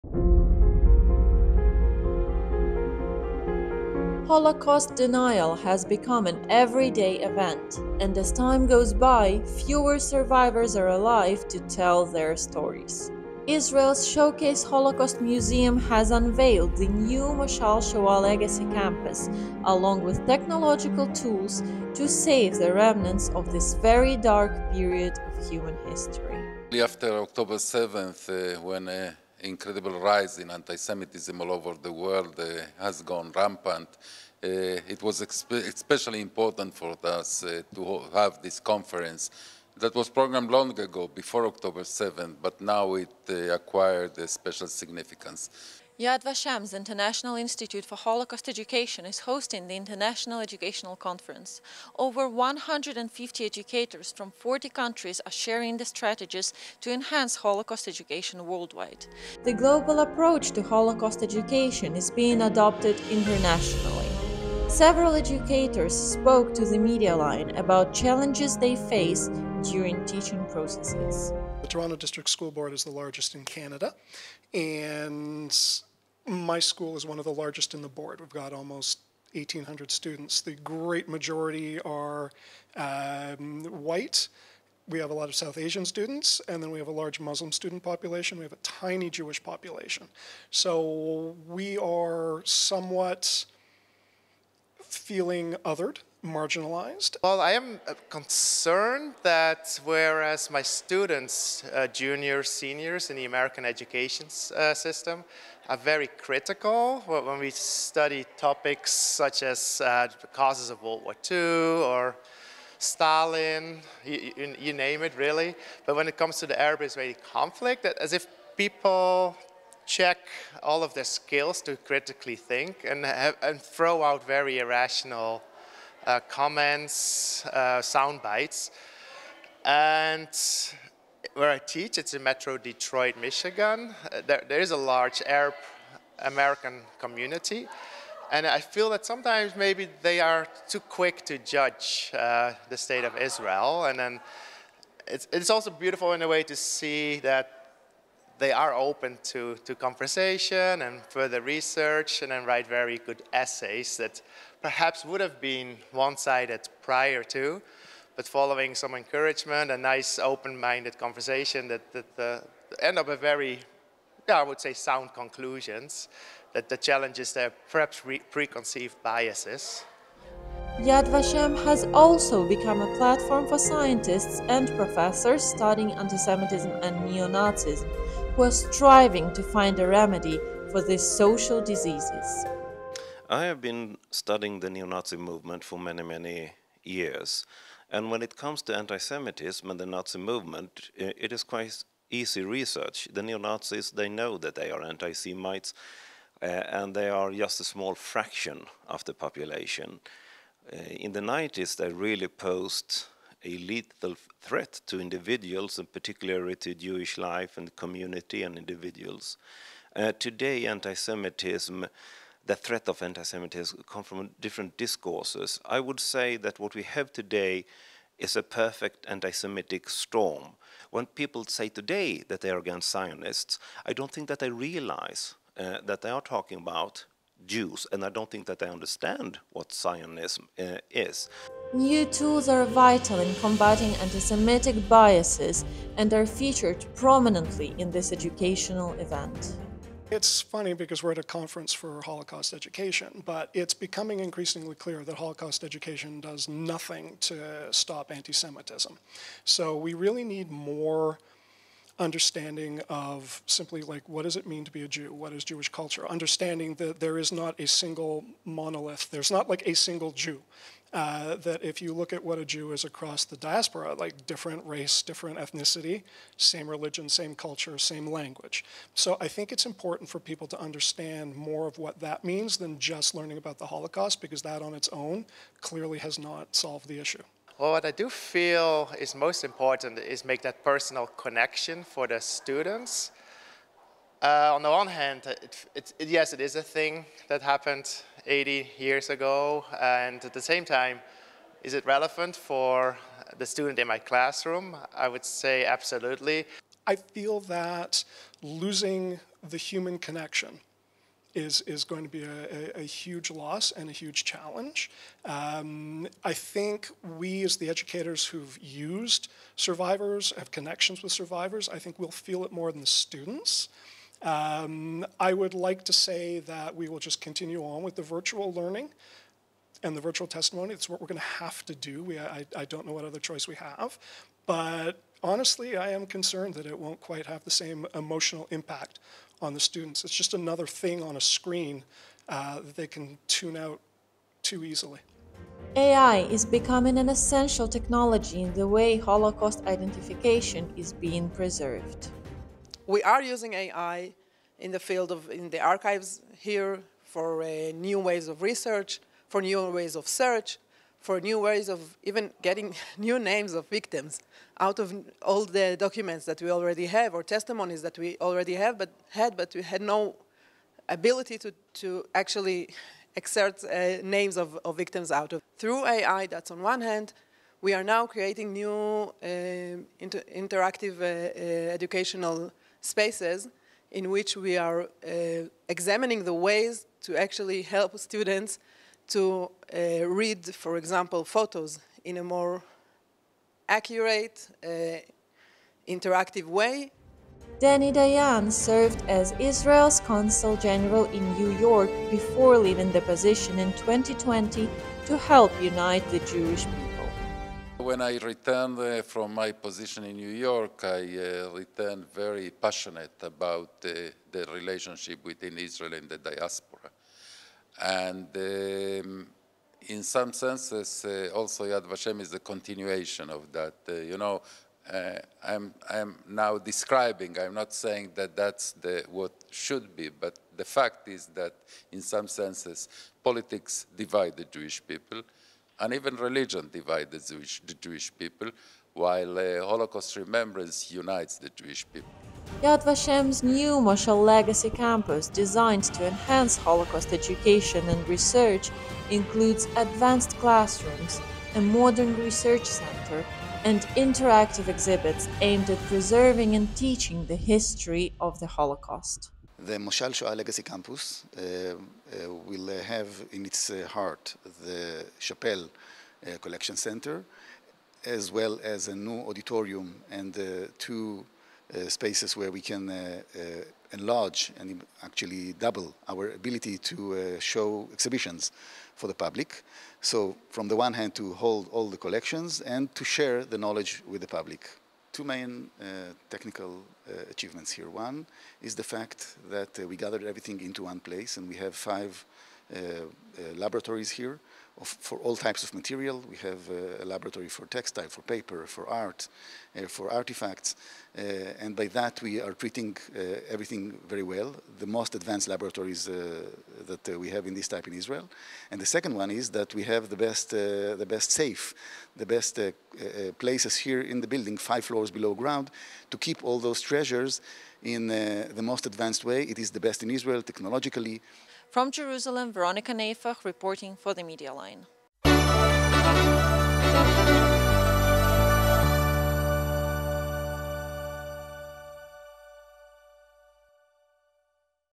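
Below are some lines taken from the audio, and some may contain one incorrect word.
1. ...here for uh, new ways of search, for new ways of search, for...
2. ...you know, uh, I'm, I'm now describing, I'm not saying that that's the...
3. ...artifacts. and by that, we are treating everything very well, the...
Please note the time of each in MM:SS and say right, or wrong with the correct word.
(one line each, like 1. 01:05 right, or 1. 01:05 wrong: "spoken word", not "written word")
1. 05:46 wrong: "research", not "search"
2. 06:53 right
3. 08:10 right.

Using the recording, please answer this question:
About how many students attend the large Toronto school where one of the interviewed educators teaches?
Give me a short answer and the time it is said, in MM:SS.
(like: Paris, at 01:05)
1,800, at 01:19.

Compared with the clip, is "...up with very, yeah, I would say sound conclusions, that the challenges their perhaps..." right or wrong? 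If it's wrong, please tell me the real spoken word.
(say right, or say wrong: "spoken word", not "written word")
right.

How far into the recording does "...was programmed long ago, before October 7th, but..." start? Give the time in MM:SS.
00:39.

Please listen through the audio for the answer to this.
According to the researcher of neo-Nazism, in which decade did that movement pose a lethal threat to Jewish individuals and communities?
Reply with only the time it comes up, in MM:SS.
03:21.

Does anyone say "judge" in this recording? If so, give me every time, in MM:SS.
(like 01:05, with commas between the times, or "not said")
02:21.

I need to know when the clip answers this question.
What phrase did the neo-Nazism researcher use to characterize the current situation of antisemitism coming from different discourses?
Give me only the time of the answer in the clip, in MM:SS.
03:38.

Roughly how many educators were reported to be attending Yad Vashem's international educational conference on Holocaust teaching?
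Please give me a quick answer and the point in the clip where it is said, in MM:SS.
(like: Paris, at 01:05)
Over 150, at 00:51.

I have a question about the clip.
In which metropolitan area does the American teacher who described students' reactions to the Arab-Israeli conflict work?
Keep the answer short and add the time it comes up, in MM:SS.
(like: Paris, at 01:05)
Metro Detroit, at 02:12.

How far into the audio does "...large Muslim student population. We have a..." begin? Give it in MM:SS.
01:26.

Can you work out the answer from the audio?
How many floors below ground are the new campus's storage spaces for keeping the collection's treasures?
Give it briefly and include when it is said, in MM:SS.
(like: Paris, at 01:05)
5, at 08:24.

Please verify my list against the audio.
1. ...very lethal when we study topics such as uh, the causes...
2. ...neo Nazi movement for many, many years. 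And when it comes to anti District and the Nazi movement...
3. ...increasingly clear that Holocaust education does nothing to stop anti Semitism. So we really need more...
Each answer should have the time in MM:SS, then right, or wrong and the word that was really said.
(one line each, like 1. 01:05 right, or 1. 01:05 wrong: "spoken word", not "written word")
1. 01:45 wrong: "critical", not "lethal"
2. 03:04 wrong: "Semitism", not "District"
3. 04:04 right.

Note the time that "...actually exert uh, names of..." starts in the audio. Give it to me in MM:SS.
06:02.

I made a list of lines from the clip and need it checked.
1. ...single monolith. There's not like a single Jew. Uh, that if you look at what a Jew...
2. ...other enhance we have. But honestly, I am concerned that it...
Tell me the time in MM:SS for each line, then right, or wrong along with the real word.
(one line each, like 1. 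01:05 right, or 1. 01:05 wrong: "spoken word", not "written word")
1. 04:17 right
2. 05:23 wrong: "choice", not "enhance".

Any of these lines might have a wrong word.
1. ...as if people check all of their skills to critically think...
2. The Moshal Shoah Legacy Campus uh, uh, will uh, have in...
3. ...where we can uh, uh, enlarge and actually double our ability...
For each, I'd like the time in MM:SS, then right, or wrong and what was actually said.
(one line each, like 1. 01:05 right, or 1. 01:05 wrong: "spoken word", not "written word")
1. 01:57 right
2. 07:29 right
3. 07:42 right.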